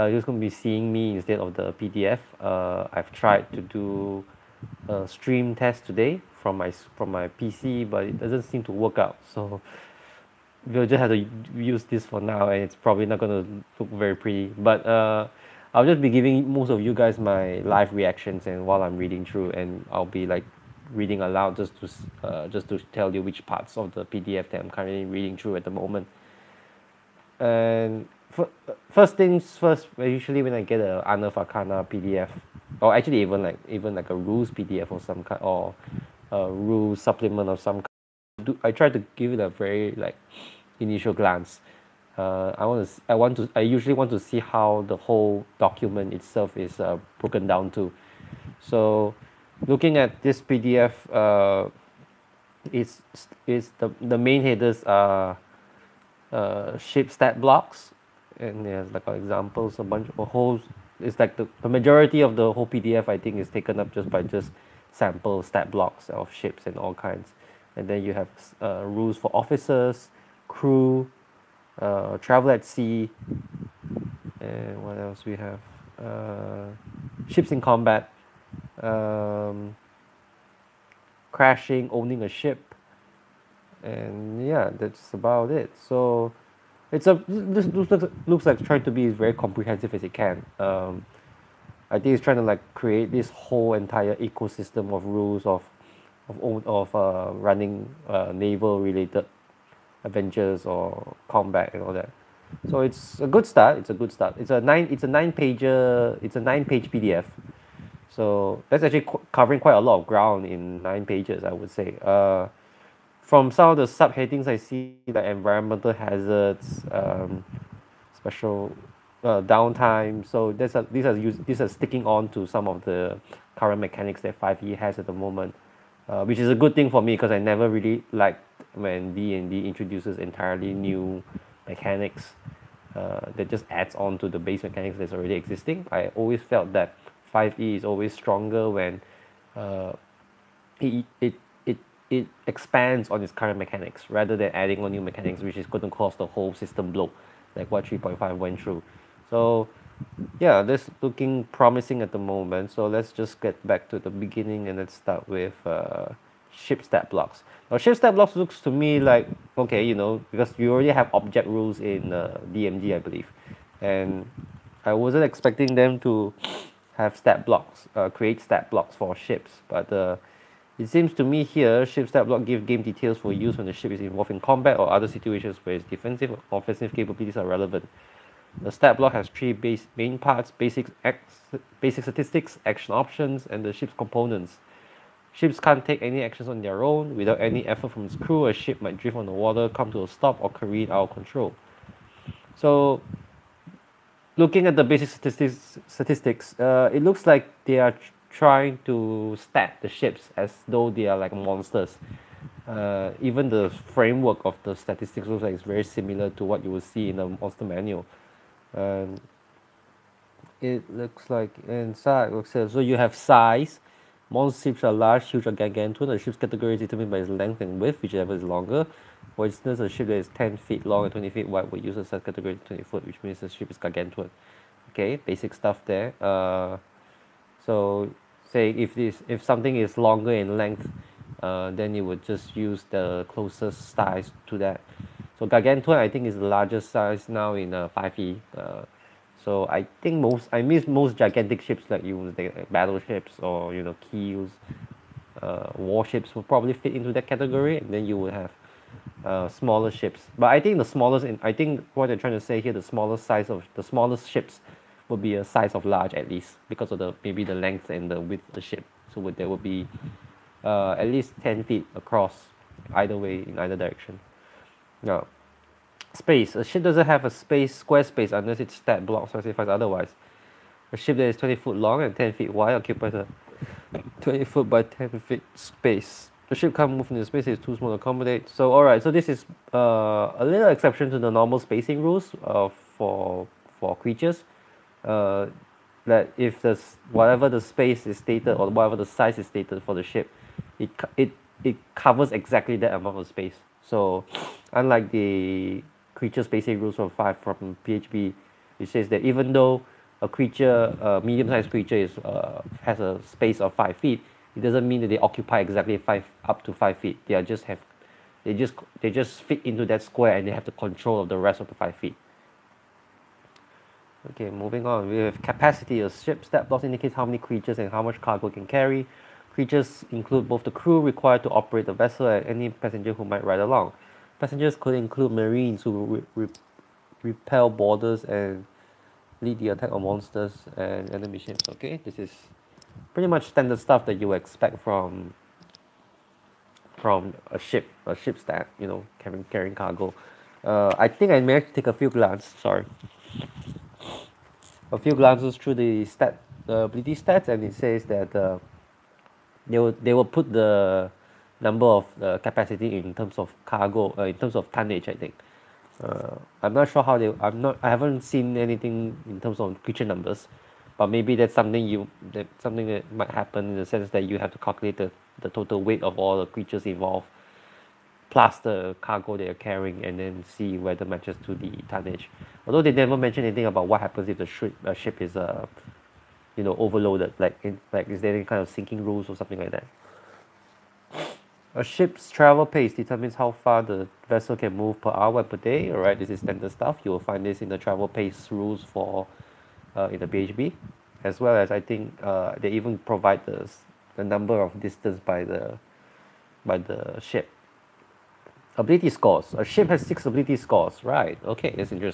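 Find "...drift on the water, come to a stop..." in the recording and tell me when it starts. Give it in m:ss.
3:08.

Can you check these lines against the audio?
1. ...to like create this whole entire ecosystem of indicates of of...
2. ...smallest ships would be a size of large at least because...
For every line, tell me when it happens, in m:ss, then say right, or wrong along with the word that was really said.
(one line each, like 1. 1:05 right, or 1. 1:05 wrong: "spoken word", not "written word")
1. 1:32 wrong: "rules", not "indicates"
2. 4:13 right.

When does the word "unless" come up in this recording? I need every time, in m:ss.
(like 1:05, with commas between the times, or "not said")
4:28.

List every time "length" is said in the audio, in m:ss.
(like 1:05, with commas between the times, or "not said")
3:37, 3:50, 4:17.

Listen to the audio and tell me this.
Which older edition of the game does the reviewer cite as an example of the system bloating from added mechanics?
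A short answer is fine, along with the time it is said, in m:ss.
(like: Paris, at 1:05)
3.5, at 2:27.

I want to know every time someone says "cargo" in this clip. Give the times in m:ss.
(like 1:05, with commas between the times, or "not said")
5:18, 5:39, 5:53, 6:09.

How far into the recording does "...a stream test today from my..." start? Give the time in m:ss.
0:04.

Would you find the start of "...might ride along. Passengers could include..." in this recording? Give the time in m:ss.
5:23.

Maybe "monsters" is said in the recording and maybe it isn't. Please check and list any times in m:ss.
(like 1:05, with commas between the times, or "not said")
3:21, 3:27, 5:30.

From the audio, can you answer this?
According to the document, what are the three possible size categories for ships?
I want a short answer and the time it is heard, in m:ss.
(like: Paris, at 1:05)
Large, huge, or gargantuan, at 3:34.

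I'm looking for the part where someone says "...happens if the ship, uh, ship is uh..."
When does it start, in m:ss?
6:14.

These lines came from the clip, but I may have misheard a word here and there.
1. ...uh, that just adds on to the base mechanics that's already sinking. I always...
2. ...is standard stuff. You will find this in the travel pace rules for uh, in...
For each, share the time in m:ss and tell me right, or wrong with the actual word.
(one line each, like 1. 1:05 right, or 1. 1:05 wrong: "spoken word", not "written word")
1. 2:12 wrong: "existing", not "sinking"
2. 6:26 right.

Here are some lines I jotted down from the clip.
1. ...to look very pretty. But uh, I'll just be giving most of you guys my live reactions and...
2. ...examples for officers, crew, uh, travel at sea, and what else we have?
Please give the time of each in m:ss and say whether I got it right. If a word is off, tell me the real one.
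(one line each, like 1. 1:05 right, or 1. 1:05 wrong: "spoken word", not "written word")
1. 0:13 right
2. 1:08 wrong: "rules", not "examples".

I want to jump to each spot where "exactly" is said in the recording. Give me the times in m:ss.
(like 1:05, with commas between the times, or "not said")
4:52, 5:05.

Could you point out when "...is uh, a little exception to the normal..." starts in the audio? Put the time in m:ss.
4:39.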